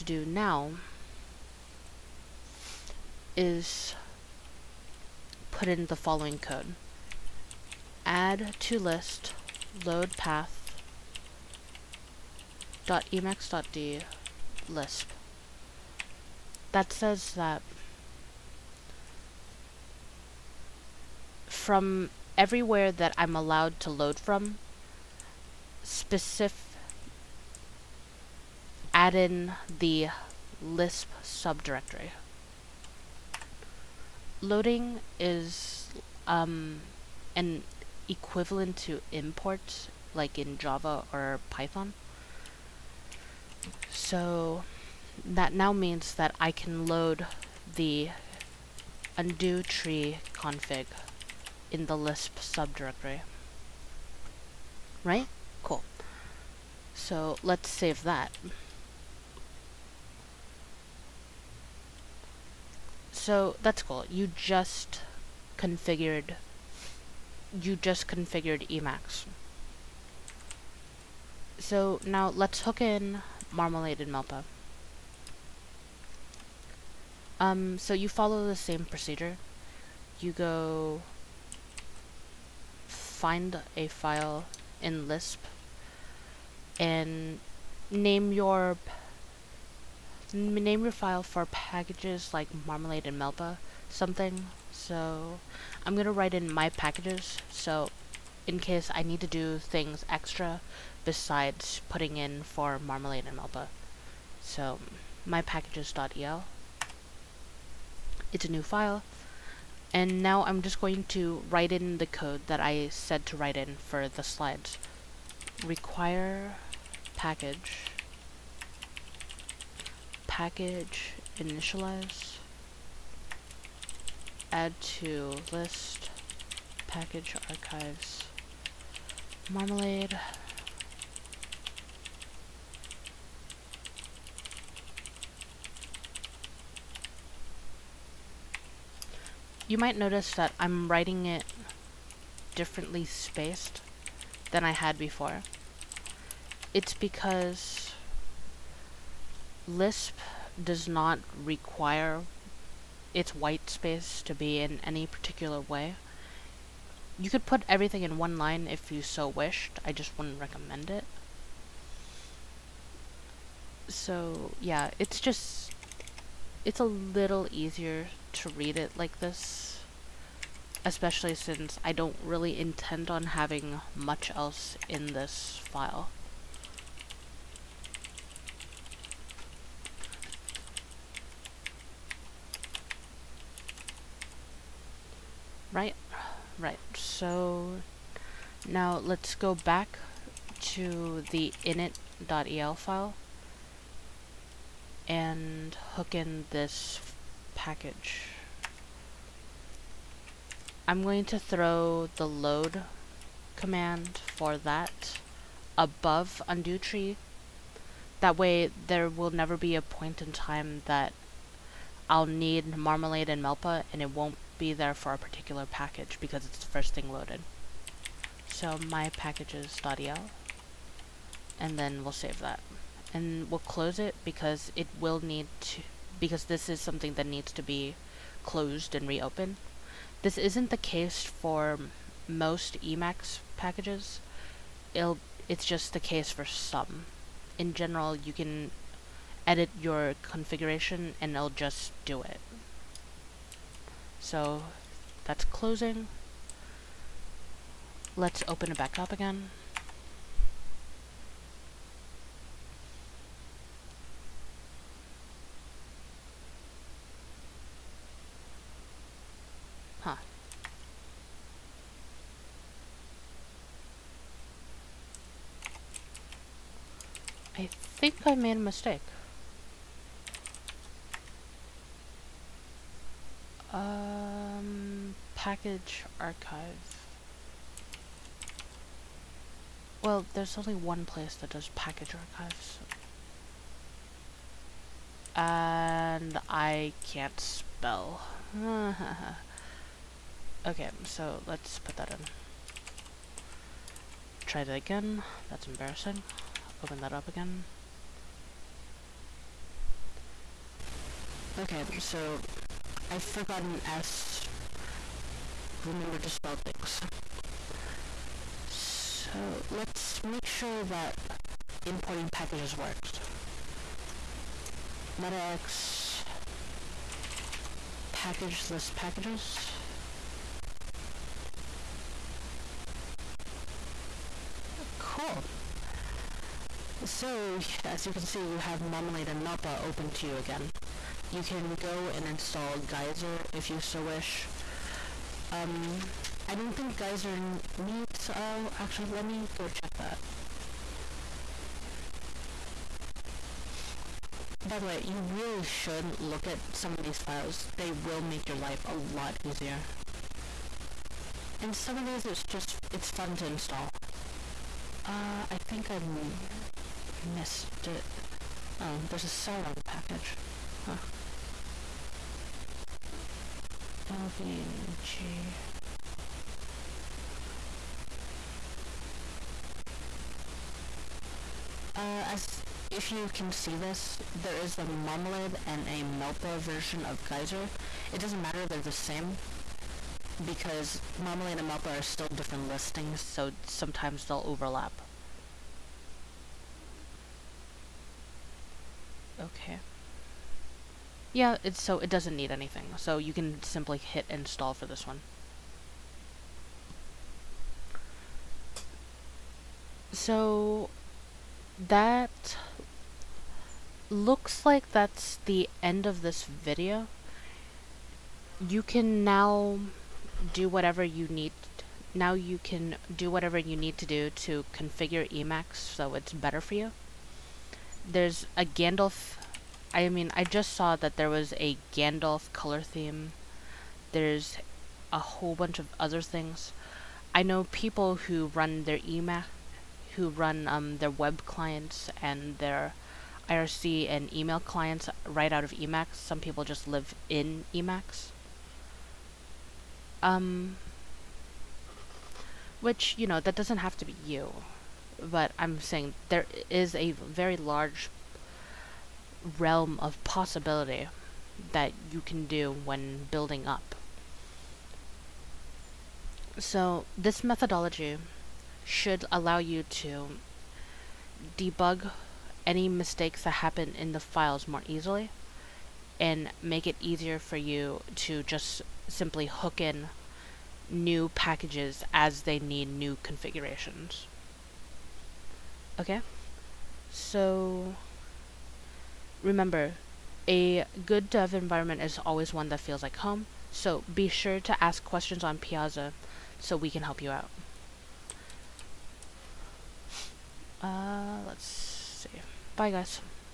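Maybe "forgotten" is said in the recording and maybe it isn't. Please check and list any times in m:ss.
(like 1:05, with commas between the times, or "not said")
5:03.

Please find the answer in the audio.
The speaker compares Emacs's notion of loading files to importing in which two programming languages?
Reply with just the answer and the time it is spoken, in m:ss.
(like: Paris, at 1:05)
Java or Python, at 0:40.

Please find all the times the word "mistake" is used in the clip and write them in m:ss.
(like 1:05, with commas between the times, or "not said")
4:28, 7:42.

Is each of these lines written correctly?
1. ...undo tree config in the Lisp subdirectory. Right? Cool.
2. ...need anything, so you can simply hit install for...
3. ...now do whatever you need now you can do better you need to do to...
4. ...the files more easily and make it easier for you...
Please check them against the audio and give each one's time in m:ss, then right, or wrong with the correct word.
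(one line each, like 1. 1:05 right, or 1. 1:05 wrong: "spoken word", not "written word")
1. 0:49 right
2. 6:32 right
3. 6:49 wrong: "whatever", not "better"
4. 7:44 right.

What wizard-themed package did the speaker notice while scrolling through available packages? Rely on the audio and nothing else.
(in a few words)
Gandalf color theme.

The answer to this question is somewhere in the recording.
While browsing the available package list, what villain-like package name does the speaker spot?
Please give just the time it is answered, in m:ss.
5:59.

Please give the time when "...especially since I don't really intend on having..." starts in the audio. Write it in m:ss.
2:50.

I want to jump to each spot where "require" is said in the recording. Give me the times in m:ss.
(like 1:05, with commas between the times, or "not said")
1:55, 2:31.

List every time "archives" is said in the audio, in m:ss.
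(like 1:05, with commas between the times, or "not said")
2:07, 4:36, 4:42.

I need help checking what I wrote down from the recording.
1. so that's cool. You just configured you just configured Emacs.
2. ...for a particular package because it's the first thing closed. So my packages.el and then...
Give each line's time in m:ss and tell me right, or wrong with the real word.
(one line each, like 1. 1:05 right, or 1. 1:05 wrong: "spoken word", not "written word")
1. 1:03 right
2. 3:34 wrong: "loaded", not "closed".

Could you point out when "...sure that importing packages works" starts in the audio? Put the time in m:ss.
5:10.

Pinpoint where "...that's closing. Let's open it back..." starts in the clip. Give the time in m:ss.
4:05.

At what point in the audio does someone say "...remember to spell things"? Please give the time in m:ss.
5:05.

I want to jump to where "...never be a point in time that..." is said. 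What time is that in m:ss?
3:29.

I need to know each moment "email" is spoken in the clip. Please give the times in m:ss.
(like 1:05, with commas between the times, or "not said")
7:09, 7:14.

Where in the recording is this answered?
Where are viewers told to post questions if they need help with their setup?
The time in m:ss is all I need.
8:05.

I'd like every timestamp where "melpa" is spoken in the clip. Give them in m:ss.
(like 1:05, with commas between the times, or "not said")
1:14, 1:33, 1:43, 3:33, 5:29, 6:16, 6:21.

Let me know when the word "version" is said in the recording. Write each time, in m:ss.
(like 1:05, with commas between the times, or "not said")
6:16.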